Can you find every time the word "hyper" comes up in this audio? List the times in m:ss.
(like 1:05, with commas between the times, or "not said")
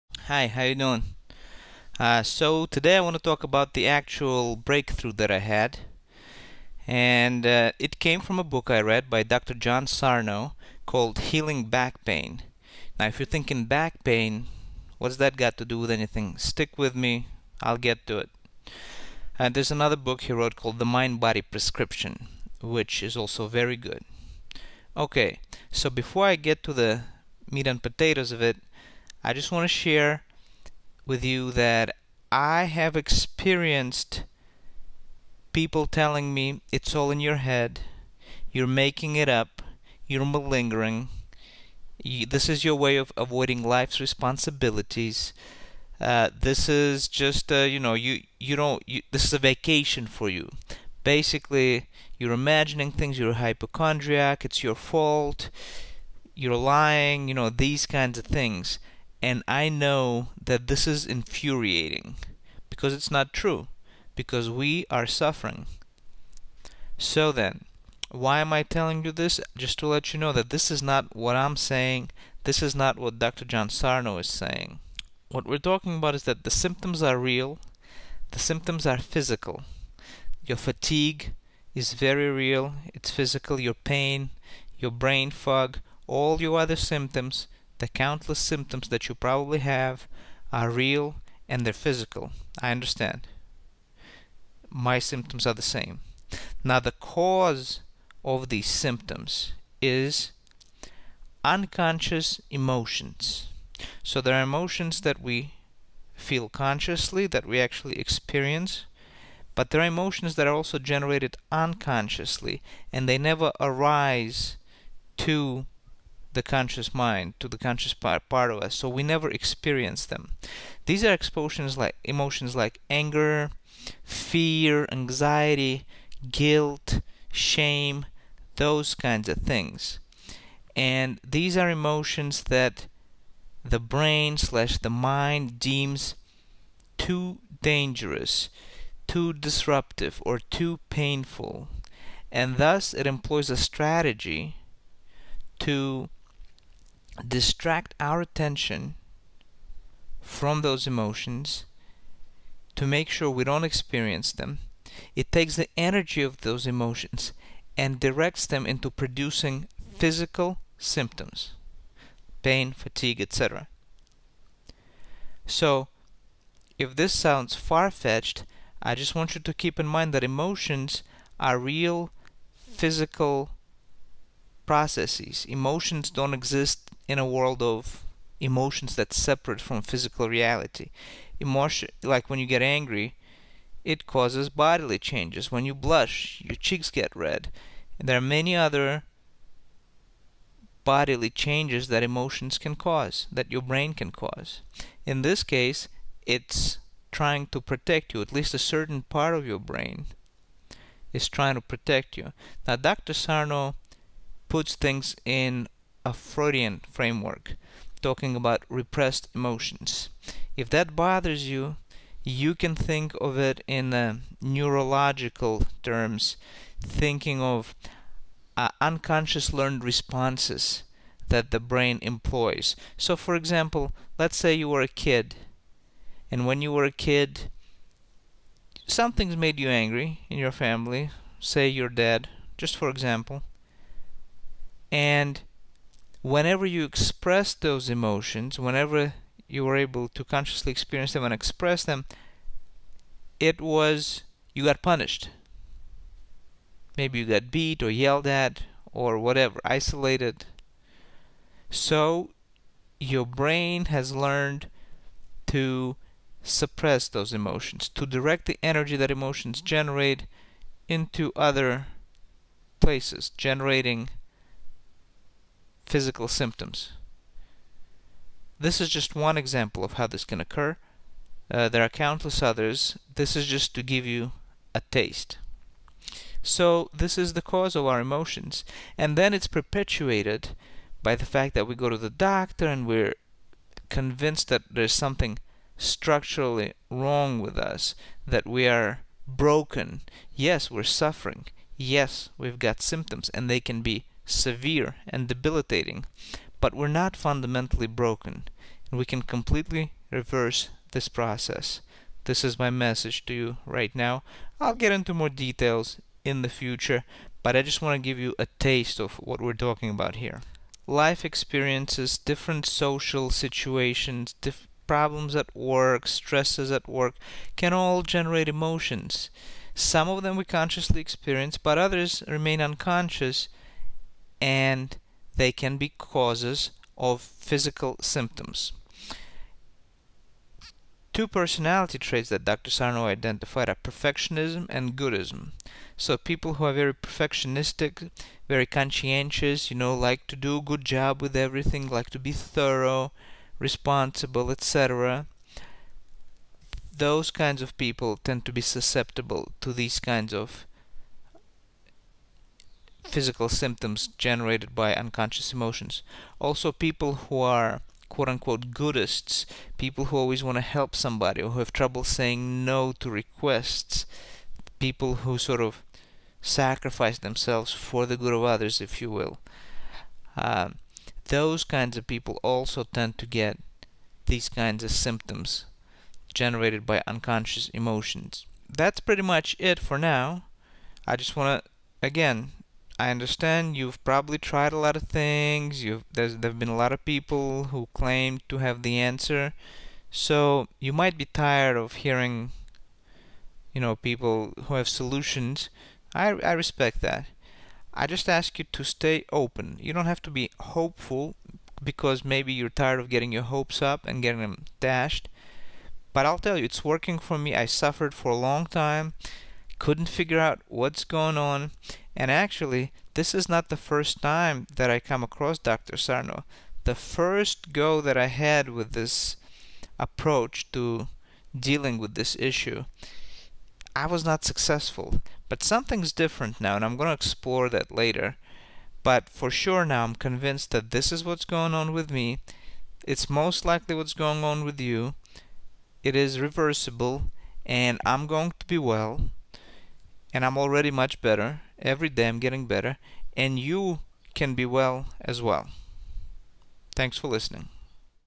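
not said.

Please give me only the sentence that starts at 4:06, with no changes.
Maybe you got beat or yelled at or whatever, isolated.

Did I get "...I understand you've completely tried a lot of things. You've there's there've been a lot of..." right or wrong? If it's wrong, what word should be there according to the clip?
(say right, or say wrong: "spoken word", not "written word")
wrong: "probably", not "completely".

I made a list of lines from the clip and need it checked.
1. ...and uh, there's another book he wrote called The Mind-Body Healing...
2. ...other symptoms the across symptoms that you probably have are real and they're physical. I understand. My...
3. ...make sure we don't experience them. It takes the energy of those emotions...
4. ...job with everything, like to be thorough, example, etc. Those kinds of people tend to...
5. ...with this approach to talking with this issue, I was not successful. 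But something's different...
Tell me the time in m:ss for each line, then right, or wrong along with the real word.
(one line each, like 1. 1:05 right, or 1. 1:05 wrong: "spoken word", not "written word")
1. 0:19 wrong: "Prescription", not "Healing"
2. 1:26 wrong: "countless", not "across"
3. 2:32 right
4. 5:40 wrong: "responsible", not "example"
5. 6:58 wrong: "dealing", not "talking".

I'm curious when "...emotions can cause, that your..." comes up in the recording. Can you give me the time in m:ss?
3:12.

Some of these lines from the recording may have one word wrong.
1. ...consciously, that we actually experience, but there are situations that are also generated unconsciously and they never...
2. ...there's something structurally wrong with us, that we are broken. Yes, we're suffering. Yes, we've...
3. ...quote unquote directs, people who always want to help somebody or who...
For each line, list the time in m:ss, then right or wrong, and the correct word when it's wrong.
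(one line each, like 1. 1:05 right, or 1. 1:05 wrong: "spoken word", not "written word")
1. 1:46 wrong: "emotions", not "situations"
2. 4:44 right
3. 5:58 wrong: "goodists", not "directs".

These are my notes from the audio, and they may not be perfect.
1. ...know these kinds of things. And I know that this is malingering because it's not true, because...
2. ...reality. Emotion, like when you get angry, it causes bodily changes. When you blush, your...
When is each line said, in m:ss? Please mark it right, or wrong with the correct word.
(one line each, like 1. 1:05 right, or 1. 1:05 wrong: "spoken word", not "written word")
1. 0:57 wrong: "infuriating", not "malingering"
2. 3:00 right.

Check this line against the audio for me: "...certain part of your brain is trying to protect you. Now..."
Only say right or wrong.
right.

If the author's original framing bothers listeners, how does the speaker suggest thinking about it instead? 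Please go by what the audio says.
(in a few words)
neurological terms.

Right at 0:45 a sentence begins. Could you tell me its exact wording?
Uh, this is just uh, you know you you don't you, this is a vacation for you.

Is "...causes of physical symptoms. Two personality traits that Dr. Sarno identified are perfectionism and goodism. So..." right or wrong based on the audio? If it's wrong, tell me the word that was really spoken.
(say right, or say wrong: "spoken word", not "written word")
right.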